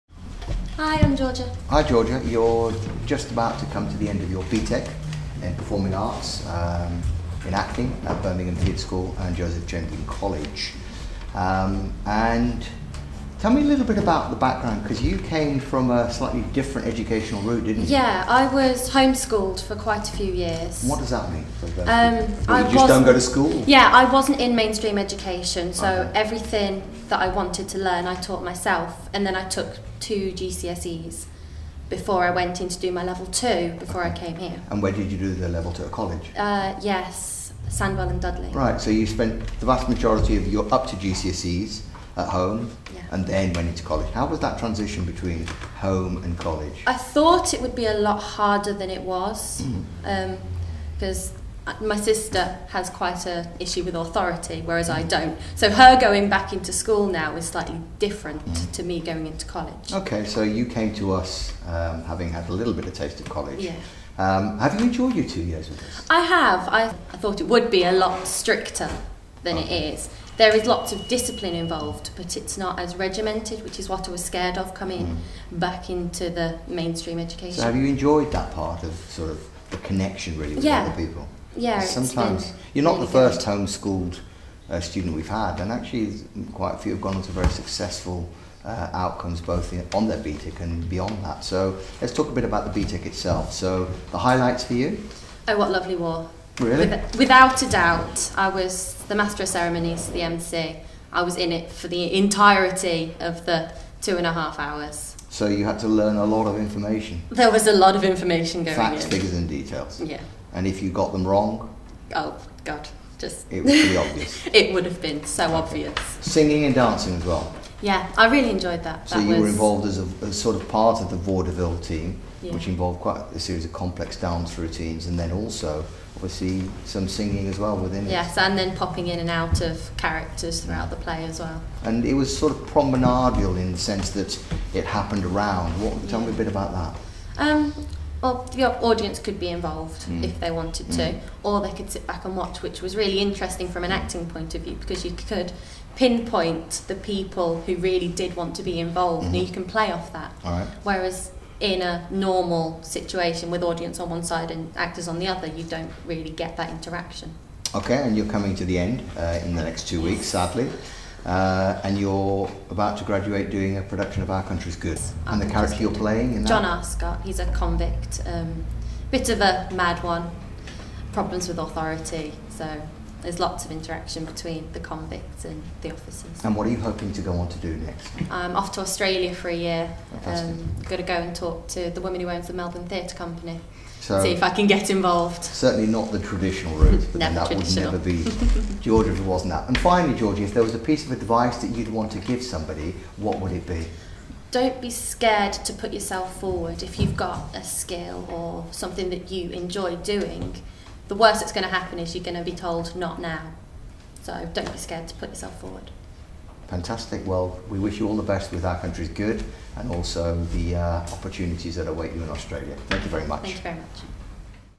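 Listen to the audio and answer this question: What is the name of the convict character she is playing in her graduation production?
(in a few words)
John Arscott.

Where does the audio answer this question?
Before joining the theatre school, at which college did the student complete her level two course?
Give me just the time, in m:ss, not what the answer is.
0:37.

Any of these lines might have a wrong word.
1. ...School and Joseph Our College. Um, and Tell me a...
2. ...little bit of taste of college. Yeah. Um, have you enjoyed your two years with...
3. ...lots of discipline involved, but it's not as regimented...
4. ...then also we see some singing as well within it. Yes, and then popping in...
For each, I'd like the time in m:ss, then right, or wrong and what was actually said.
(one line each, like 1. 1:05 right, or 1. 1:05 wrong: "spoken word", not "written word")
1. 0:08 wrong: "Jenkin", not "Our"
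2. 1:02 right
3. 1:10 right
4. 2:05 right.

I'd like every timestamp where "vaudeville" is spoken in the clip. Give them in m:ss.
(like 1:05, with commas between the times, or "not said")
2:01.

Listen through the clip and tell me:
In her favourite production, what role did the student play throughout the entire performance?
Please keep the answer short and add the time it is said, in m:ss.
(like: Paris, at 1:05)
Master of ceremonies, at 1:39.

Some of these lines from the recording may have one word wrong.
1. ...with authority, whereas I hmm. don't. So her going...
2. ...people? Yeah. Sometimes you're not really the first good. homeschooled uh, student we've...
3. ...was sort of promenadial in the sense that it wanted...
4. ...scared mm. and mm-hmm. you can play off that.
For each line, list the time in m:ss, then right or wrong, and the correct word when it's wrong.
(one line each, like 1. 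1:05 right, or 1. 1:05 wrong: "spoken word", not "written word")
1. 0:53 right
2. 1:21 right
3. 2:12 wrong: "happened", not "wanted"
4. 2:28 wrong: "involved", not "scared".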